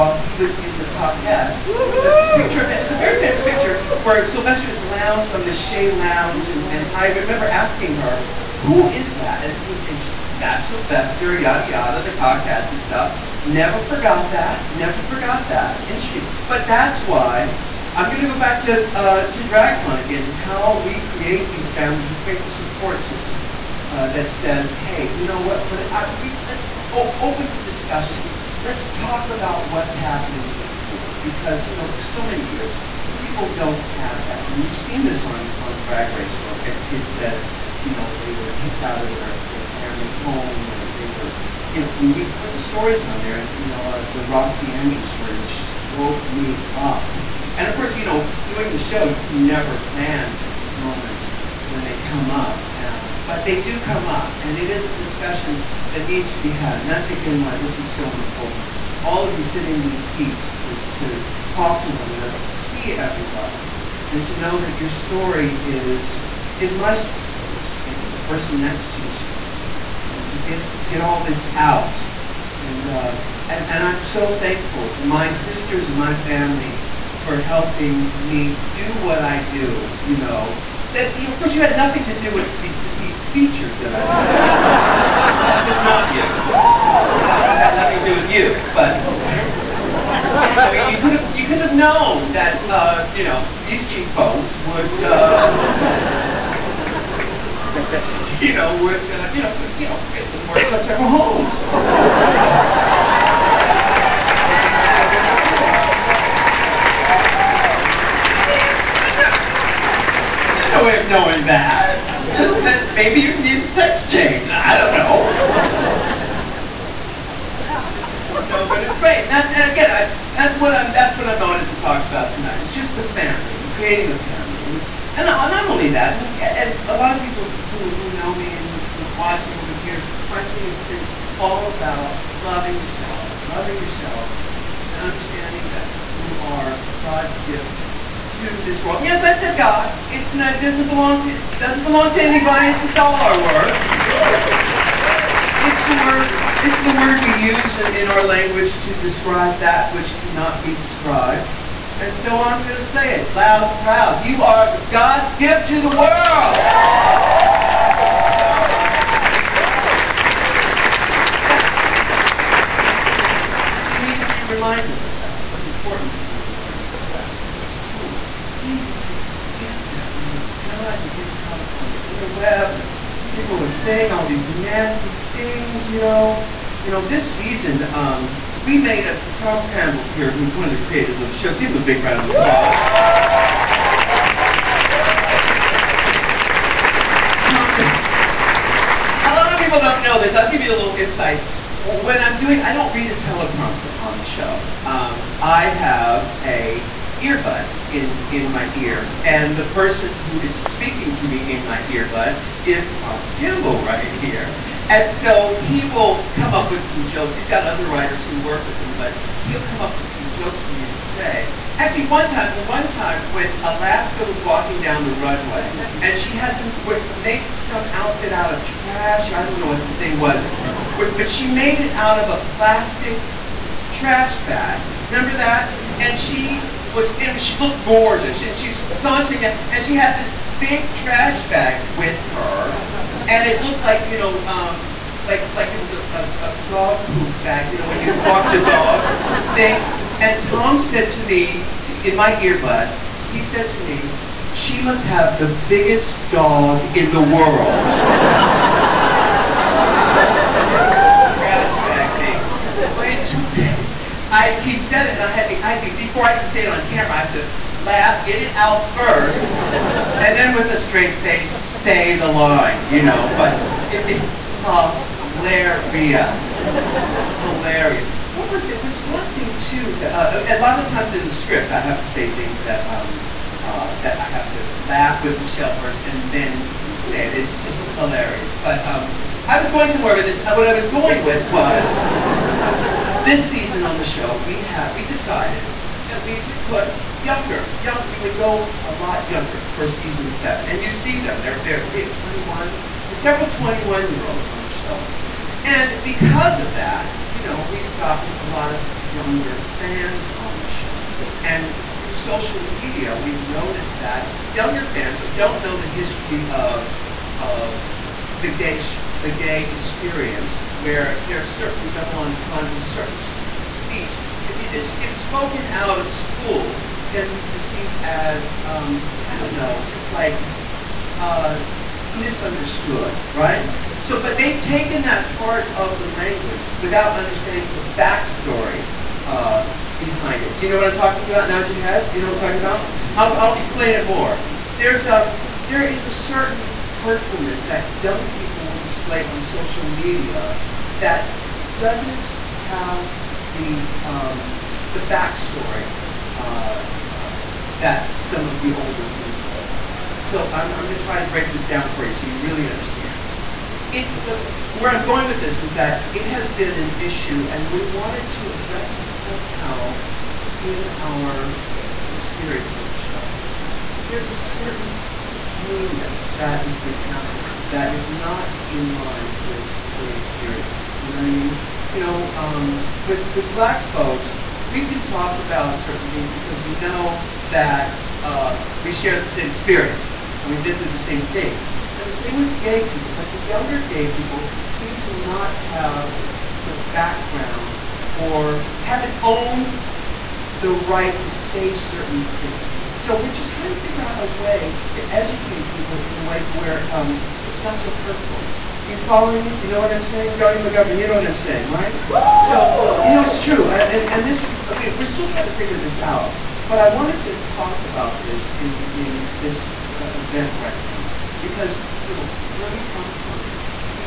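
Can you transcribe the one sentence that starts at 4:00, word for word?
And Tom said to me, in my earbud, he said to me, she must have the biggest dog in the world.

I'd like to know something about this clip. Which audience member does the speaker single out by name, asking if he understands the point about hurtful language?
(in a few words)
Johnny McGovern.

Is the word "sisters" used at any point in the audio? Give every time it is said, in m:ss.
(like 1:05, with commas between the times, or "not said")
1:15.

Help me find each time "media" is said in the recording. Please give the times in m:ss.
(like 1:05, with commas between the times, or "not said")
5:02, 5:39.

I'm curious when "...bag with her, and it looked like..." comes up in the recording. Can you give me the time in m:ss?
3:51.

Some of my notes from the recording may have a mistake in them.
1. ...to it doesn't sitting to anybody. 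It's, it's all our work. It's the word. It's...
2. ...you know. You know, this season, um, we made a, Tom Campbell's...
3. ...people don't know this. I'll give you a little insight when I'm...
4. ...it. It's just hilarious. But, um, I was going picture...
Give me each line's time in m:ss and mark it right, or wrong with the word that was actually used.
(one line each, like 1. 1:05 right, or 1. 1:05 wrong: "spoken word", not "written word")
1. 2:21 wrong: "belong", not "sitting"
2. 2:55 right
3. 3:09 right
4. 4:37 wrong: "somewhere", not "picture".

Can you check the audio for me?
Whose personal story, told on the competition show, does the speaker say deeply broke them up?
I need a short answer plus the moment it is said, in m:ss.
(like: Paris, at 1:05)
Roxy Andrews, at 0:44.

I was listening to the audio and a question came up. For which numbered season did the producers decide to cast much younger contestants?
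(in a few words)
season 7.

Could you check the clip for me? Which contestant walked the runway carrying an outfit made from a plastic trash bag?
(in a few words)
Alaska.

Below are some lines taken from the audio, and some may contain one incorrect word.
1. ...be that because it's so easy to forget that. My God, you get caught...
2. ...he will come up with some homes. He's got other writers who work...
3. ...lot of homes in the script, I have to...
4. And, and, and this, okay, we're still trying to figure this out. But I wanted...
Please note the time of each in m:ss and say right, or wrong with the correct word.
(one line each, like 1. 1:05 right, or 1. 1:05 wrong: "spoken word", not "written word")
1. 2:46 right
2. 3:25 wrong: "jokes", not "homes"
3. 4:30 wrong: "times", not "homes"
4. 6:43 right.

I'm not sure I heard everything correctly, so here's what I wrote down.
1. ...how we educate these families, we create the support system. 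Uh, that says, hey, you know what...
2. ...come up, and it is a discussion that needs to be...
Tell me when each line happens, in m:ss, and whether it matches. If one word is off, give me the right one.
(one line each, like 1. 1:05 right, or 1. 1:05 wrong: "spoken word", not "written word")
1. 0:20 wrong: "create", not "educate"
2. 0:53 right.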